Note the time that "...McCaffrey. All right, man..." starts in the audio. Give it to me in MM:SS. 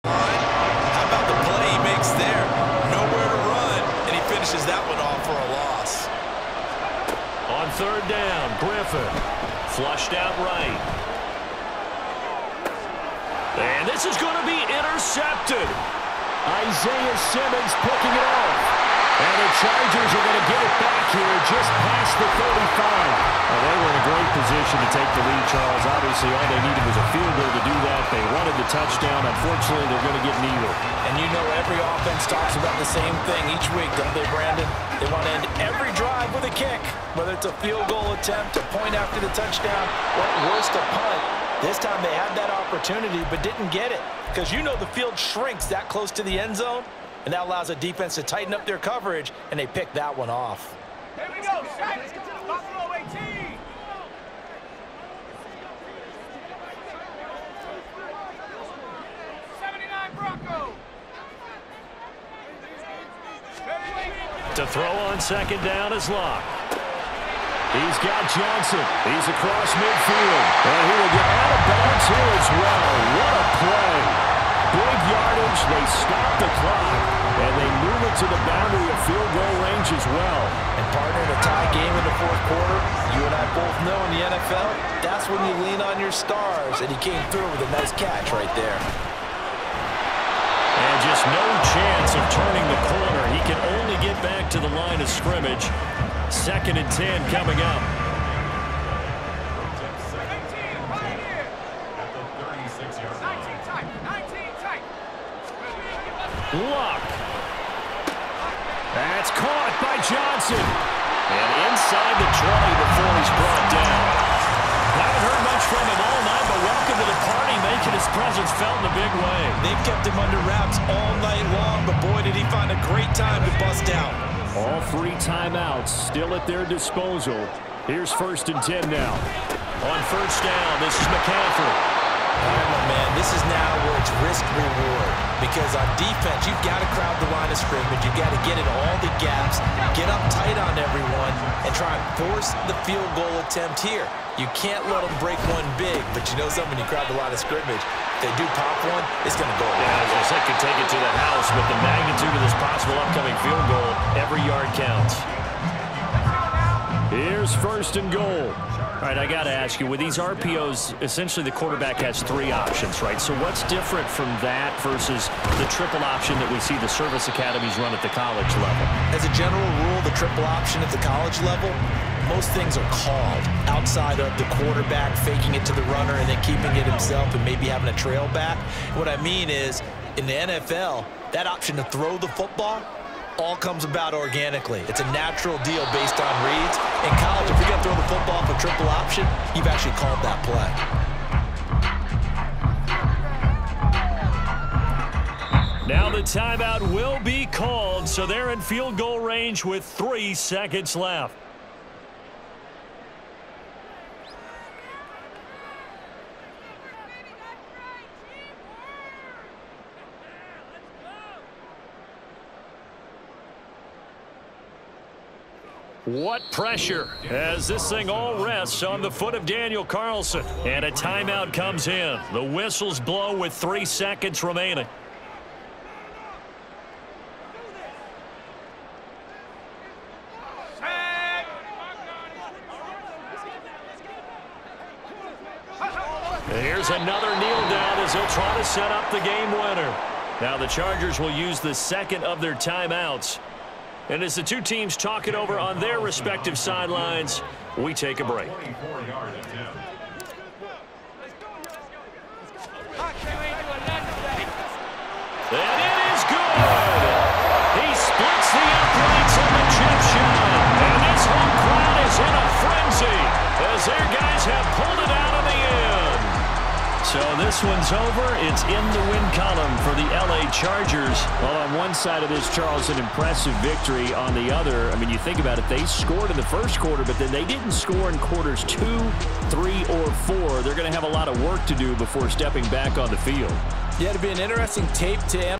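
02:11.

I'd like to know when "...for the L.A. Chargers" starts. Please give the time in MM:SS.
04:29.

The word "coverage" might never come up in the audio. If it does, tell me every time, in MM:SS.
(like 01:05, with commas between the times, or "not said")
00:48.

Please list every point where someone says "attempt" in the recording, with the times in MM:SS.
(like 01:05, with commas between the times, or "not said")
00:38, 02:23.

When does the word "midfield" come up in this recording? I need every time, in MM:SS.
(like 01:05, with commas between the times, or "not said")
01:09.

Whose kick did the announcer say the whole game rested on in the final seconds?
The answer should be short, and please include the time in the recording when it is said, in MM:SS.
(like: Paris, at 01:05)
Daniel Carlson, at 03:39.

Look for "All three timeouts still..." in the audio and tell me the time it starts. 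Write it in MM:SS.
02:04.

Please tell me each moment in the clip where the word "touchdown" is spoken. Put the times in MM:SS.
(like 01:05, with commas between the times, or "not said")
00:28, 00:39.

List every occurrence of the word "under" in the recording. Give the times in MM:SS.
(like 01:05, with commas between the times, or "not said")
02:00.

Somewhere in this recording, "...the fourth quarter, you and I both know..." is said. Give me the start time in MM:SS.
01:22.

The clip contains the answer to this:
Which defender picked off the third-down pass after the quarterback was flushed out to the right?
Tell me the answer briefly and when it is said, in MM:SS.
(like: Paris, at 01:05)
Isaiah Simmons, at 00:16.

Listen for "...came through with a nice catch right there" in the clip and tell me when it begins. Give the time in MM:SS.
01:26.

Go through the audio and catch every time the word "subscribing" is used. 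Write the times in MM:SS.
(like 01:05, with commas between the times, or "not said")
not said.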